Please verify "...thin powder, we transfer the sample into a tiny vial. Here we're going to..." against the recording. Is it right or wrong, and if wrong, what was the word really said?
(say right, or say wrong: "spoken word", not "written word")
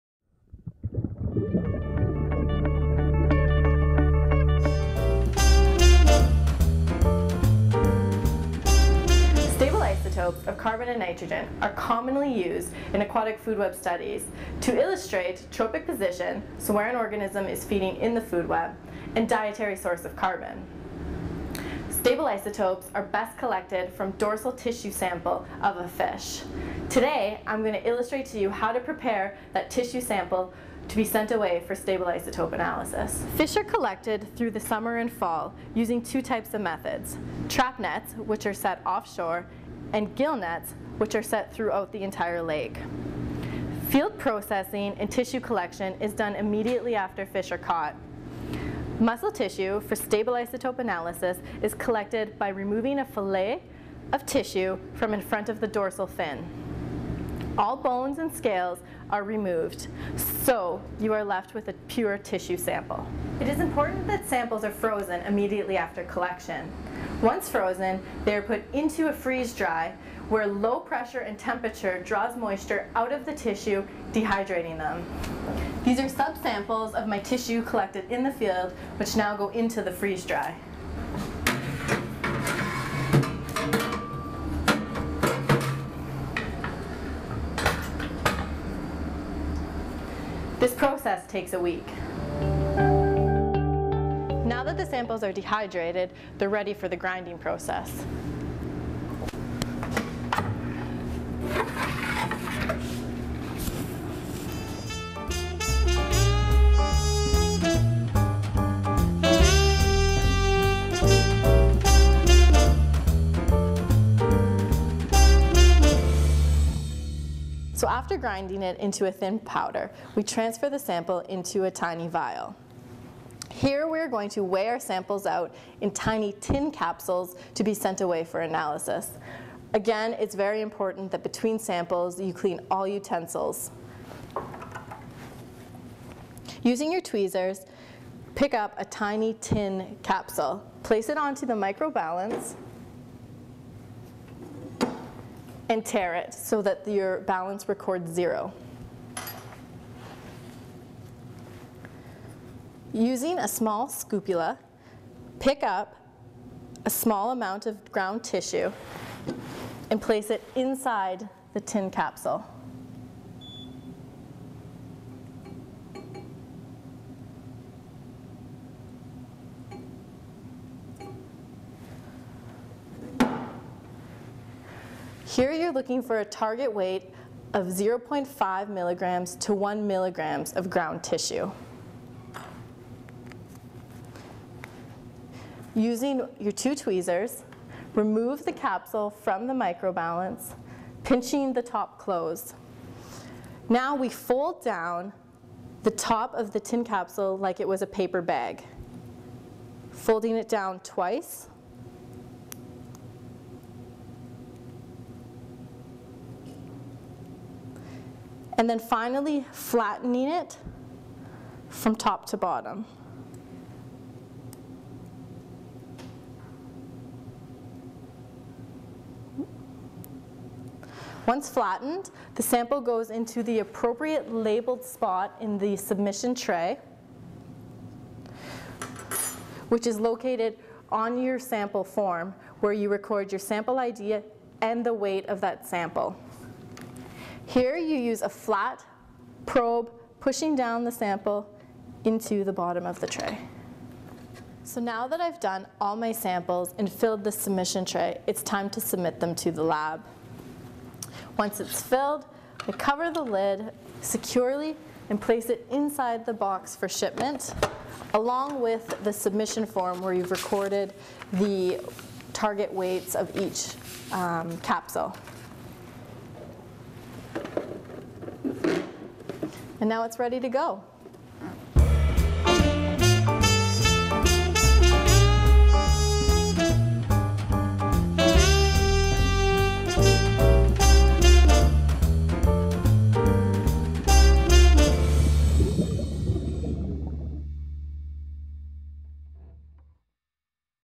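right.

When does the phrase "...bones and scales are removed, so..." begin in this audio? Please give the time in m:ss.
0:57.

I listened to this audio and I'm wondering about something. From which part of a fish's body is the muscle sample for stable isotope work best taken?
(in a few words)
Dorsal tissue.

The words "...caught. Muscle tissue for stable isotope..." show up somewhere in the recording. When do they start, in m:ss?
0:47.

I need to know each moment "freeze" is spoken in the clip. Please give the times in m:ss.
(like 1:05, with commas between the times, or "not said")
1:09, 1:19.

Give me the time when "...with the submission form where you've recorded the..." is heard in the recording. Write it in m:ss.
4:18.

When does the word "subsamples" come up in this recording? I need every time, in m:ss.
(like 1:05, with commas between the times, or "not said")
1:16.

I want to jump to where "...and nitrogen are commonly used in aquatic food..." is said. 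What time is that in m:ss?
0:10.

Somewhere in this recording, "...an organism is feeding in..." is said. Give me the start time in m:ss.
0:16.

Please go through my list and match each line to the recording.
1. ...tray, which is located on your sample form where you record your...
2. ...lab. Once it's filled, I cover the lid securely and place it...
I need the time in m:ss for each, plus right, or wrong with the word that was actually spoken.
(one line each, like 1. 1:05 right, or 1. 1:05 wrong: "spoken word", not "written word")
1. 3:46 right
2. 4:09 right.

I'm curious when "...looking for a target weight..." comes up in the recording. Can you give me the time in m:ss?
2:55.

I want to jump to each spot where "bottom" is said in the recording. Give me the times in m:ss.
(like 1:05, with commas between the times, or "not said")
3:32, 4:02.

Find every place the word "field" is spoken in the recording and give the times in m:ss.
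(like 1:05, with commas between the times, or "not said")
0:43, 1:18.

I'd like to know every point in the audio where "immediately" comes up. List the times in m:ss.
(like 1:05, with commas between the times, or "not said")
0:46, 1:05.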